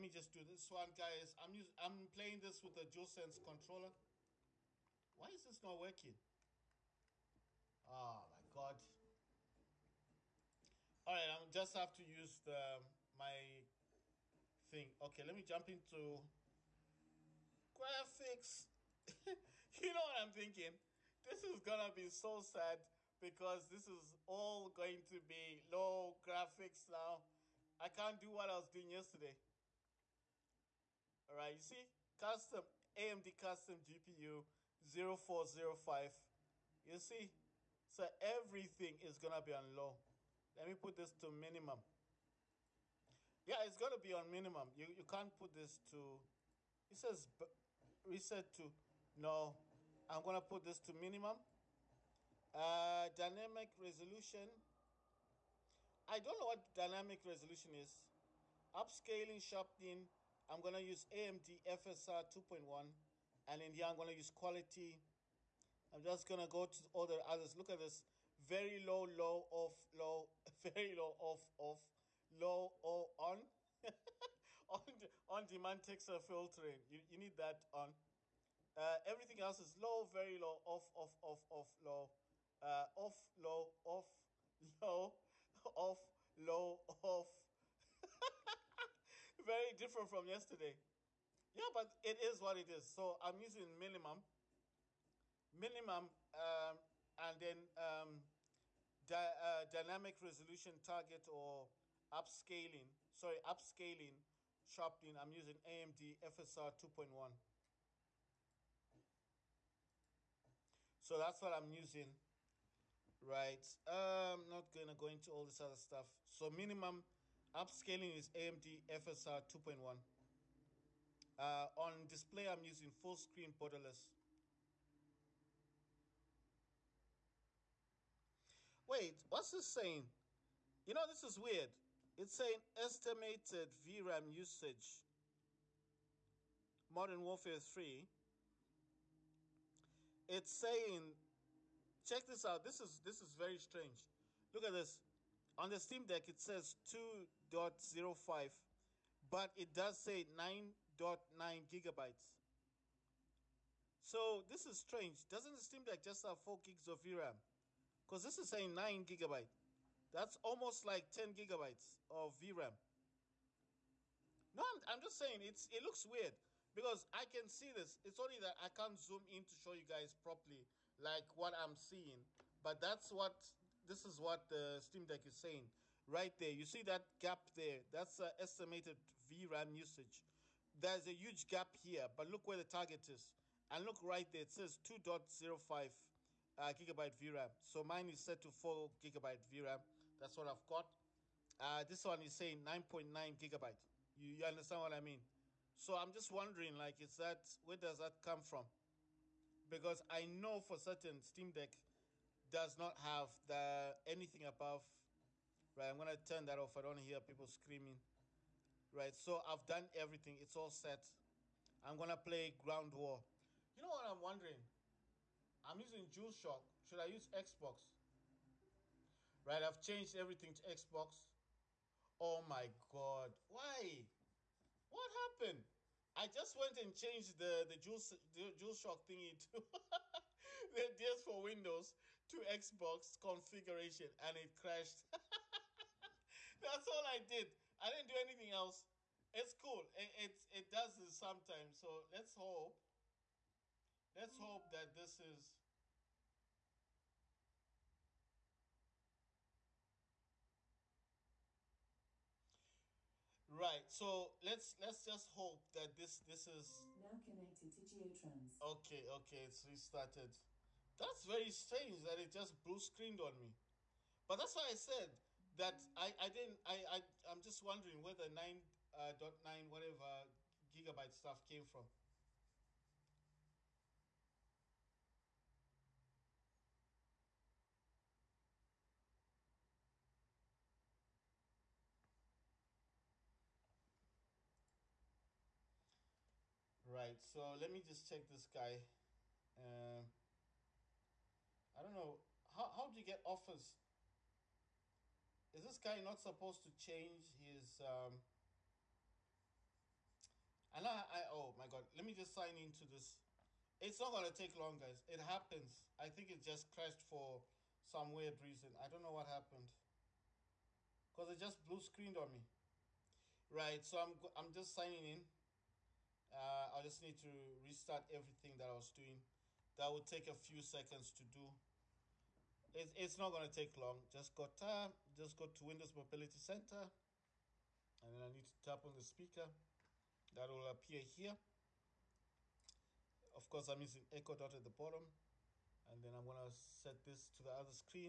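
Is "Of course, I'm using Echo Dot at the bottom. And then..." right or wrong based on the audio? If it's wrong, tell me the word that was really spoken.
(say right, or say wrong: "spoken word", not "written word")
right.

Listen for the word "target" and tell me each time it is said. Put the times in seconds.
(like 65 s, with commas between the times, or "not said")
100 s, 182 s.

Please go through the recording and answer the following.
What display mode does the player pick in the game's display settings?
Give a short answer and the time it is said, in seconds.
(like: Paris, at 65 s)
Full screen borderless, at 122 s.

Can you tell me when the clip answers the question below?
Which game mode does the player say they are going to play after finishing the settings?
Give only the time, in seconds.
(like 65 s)
212 s.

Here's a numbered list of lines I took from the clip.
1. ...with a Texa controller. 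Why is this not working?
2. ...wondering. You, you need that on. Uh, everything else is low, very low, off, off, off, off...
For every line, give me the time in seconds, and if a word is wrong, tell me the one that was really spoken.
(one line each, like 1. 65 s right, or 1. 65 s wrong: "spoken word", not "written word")
1. 2 s wrong: "DualSense", not "Texa"
2. 76 s wrong: "filtering", not "wondering".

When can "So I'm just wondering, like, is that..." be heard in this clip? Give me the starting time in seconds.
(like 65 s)
195 s.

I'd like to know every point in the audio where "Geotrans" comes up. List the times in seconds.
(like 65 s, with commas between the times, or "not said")
257 s.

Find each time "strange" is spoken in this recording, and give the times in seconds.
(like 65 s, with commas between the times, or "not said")
143 s, 154 s, 261 s.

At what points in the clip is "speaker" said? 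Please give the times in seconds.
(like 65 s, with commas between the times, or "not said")
329 s.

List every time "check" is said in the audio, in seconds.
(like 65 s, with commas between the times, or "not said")
142 s, 288 s.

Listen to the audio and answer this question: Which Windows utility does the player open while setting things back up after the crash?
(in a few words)
Windows Mobility Center.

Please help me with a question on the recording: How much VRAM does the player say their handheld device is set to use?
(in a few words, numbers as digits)
4 gigabytes.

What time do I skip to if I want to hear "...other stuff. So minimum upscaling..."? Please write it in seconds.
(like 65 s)
115 s.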